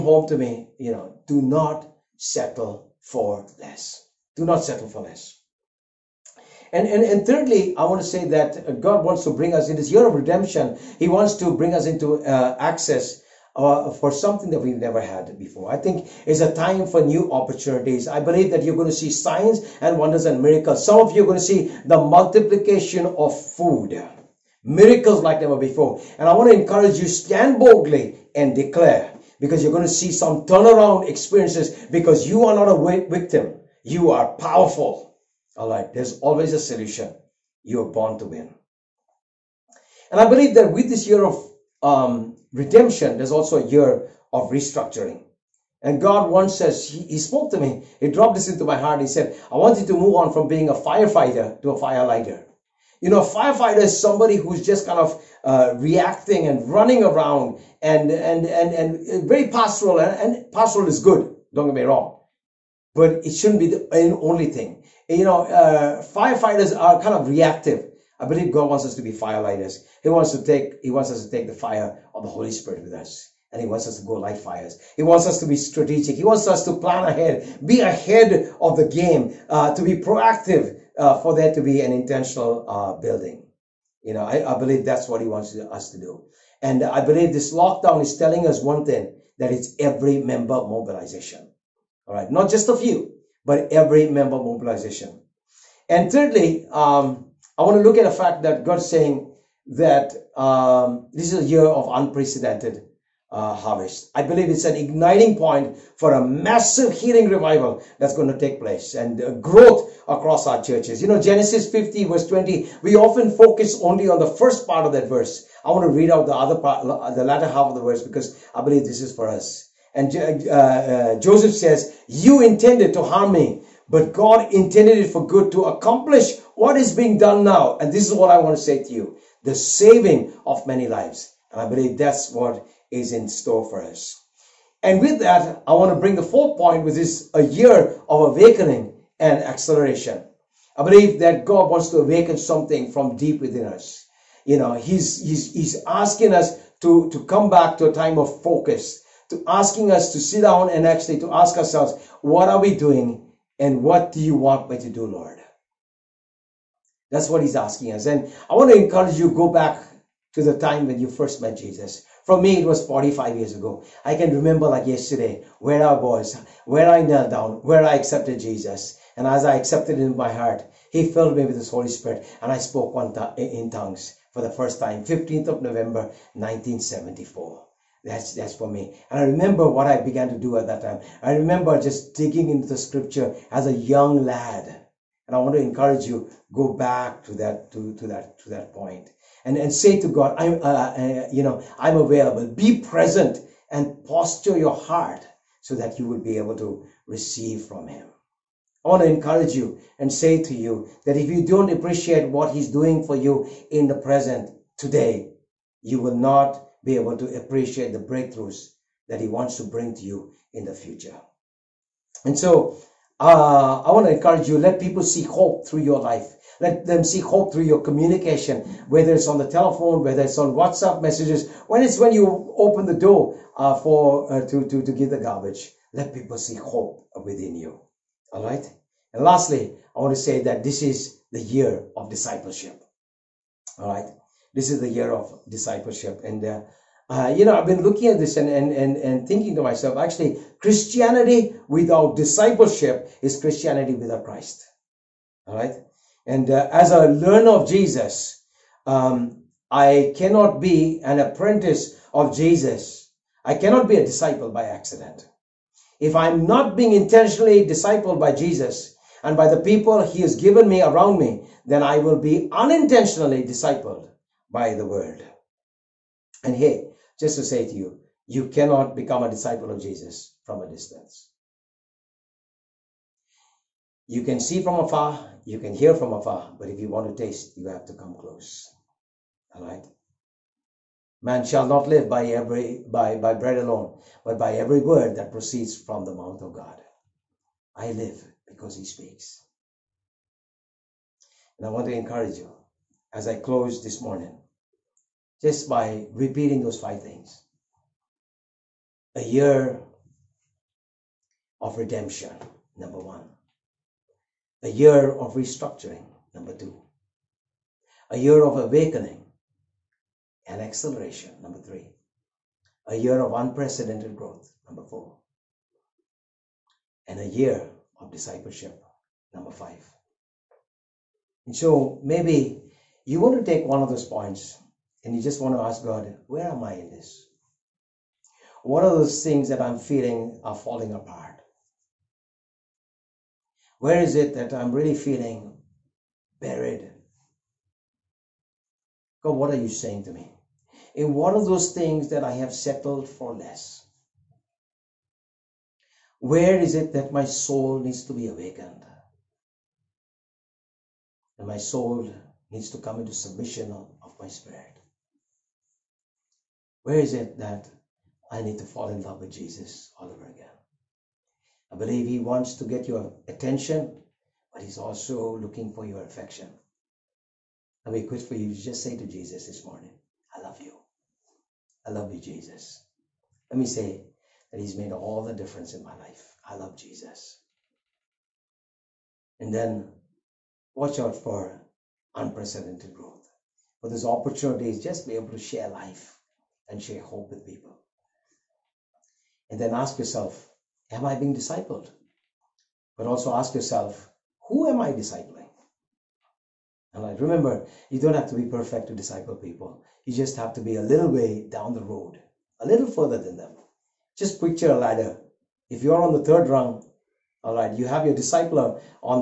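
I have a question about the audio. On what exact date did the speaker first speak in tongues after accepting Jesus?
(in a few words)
15 November 1974.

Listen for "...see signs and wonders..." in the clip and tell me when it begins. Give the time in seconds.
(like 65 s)
18 s.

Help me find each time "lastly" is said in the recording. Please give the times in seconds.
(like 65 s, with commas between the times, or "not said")
229 s.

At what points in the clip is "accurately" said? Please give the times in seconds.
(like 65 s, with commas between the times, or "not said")
not said.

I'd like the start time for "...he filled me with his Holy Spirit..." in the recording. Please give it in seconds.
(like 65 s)
170 s.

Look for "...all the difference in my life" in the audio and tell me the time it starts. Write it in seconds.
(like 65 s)
374 s.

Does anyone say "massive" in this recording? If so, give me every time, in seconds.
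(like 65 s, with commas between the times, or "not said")
106 s.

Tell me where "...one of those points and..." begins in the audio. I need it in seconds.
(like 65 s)
323 s.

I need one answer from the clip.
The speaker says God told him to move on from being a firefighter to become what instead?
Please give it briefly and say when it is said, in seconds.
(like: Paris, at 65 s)
Firelighter, at 51 s.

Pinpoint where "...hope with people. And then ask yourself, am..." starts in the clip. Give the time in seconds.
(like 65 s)
387 s.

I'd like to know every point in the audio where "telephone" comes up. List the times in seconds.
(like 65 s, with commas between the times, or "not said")
219 s.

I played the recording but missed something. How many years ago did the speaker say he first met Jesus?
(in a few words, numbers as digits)
45.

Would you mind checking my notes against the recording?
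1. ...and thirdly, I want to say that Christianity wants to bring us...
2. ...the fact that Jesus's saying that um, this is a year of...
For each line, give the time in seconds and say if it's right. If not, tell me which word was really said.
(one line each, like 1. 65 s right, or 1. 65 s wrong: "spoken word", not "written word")
1. 7 s wrong: "God", not "Christianity"
2. 98 s wrong: "God", not "Jesus".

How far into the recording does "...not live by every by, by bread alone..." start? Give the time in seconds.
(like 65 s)
281 s.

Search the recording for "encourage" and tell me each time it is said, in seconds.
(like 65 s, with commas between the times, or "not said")
26 s, 158 s, 185 s, 199 s, 214 s, 291 s.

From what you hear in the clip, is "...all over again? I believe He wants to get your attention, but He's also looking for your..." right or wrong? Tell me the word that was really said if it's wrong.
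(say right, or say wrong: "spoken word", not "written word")
right.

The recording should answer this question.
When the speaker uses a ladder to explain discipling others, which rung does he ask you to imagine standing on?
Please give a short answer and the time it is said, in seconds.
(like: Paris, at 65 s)
Third rung, at 406 s.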